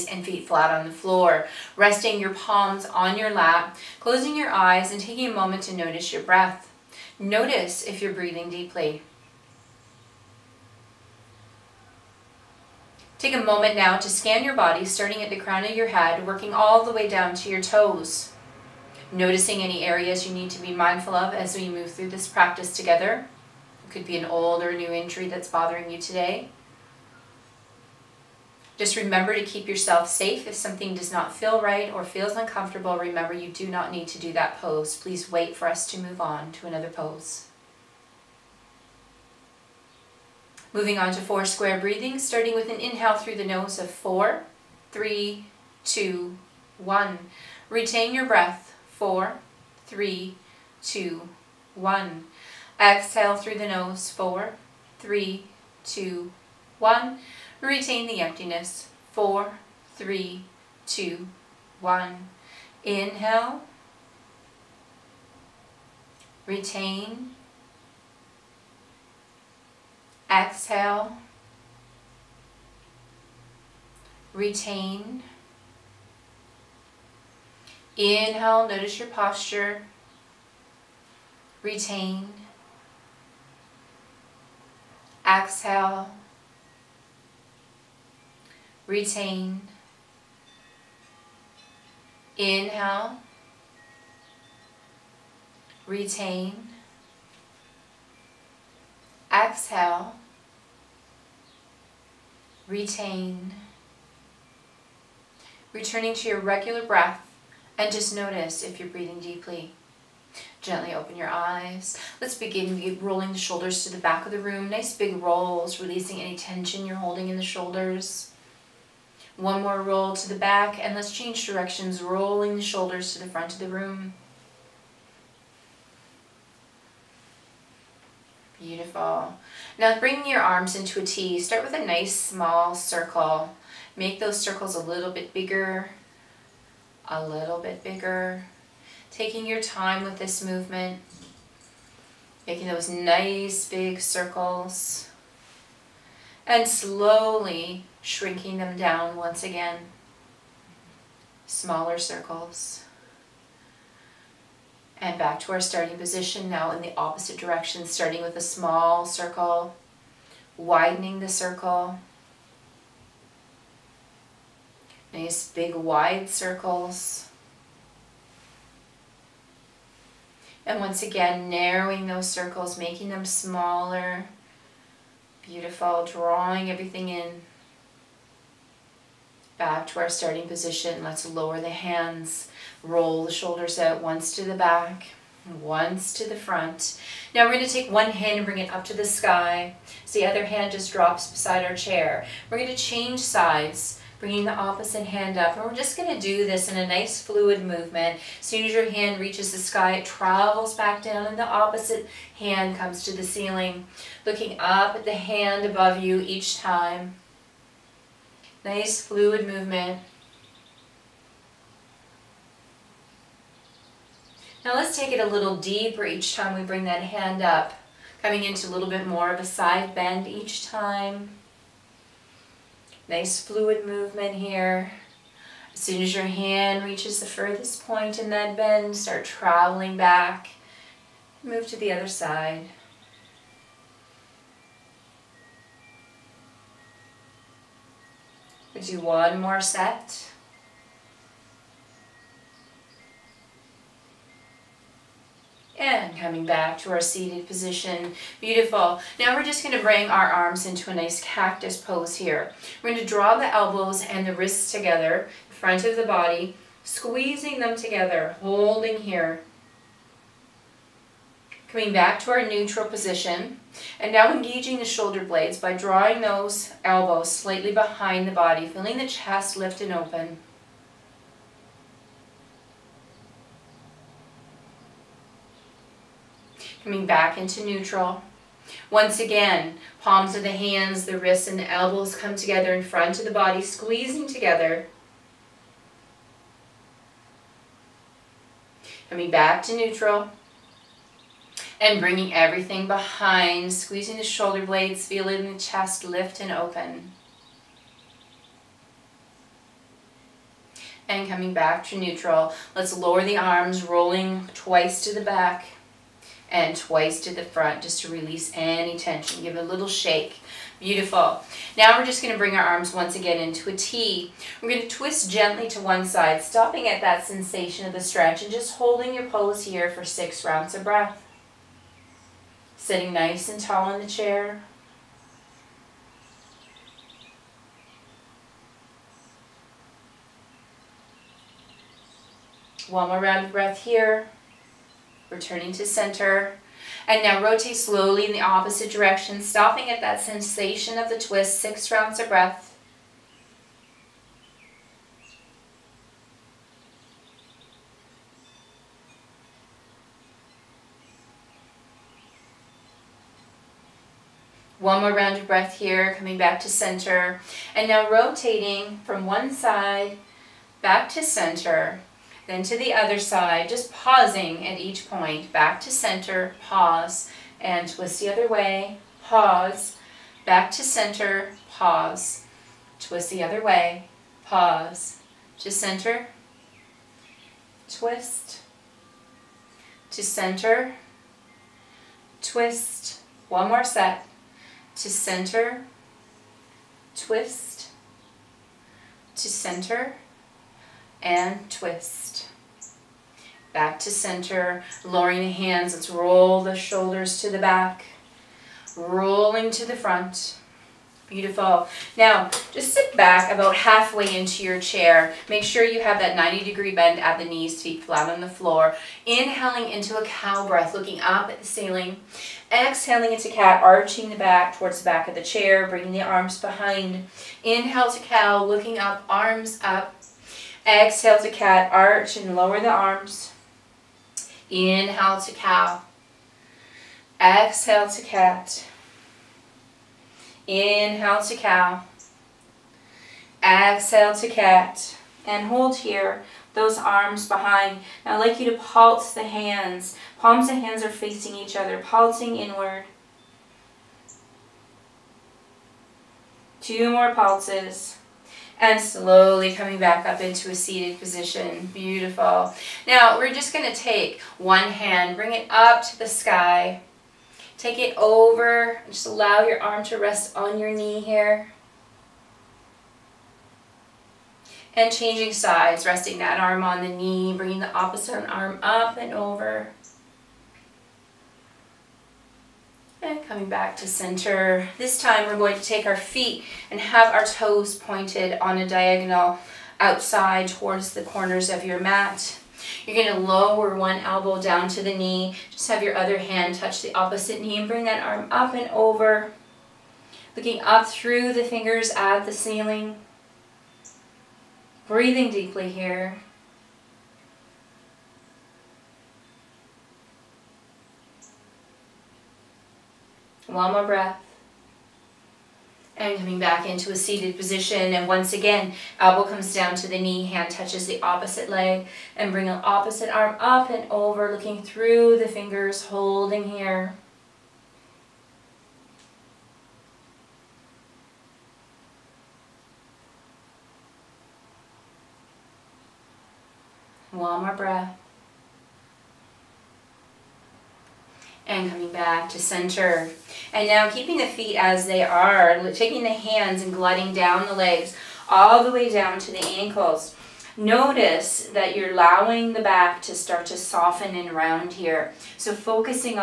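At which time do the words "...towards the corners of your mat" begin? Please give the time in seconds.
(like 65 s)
480 s.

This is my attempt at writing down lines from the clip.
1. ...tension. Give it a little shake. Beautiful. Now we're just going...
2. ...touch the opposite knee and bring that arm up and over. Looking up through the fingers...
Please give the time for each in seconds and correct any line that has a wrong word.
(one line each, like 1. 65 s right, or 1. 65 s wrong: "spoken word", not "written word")
1. 308 s right
2. 486 s right.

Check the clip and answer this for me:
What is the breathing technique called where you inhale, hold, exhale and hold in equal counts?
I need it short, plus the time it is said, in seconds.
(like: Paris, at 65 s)
four square breathing, at 41 s.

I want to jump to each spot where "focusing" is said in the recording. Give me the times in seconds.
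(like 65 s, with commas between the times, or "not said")
545 s.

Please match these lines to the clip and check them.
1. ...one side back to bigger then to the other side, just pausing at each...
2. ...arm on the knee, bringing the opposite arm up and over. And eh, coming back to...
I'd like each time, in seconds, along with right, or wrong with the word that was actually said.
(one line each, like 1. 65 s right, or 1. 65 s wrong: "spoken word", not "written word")
1. 359 s wrong: "center", not "bigger"
2. 466 s right.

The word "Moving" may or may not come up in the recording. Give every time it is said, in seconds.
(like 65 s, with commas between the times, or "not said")
40 s.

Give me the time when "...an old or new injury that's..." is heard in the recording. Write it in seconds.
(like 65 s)
24 s.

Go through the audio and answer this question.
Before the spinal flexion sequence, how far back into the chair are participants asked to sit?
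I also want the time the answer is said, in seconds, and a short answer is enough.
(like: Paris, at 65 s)
about halfway, at 403 s.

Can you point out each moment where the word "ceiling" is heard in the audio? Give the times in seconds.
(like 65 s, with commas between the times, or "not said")
203 s, 411 s, 492 s.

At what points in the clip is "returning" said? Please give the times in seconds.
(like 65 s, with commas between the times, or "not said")
105 s, 335 s.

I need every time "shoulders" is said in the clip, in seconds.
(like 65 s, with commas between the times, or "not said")
113 s, 117 s, 122 s, 183 s, 264 s, 294 s, 396 s.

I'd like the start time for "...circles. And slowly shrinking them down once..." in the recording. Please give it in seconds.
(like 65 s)
144 s.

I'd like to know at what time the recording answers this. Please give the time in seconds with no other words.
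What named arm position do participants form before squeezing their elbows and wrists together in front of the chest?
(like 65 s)
251 s.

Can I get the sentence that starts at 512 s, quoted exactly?
And bring the opposite arm up and over, looking through the fingers, holding here.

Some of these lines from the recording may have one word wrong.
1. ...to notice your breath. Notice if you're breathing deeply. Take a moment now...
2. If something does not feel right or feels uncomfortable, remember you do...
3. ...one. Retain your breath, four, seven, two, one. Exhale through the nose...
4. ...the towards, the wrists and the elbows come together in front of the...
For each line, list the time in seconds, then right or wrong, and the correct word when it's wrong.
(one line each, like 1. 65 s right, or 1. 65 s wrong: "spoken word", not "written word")
1. 5 s right
2. 30 s right
3. 46 s wrong: "three", not "seven"
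4. 280 s wrong: "hands", not "towards".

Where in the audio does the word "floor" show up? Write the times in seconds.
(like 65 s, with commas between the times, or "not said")
0 s, 408 s.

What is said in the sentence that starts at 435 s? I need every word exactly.
And hold here those arms behind.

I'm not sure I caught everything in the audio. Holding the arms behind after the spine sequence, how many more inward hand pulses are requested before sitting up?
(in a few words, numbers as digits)
2.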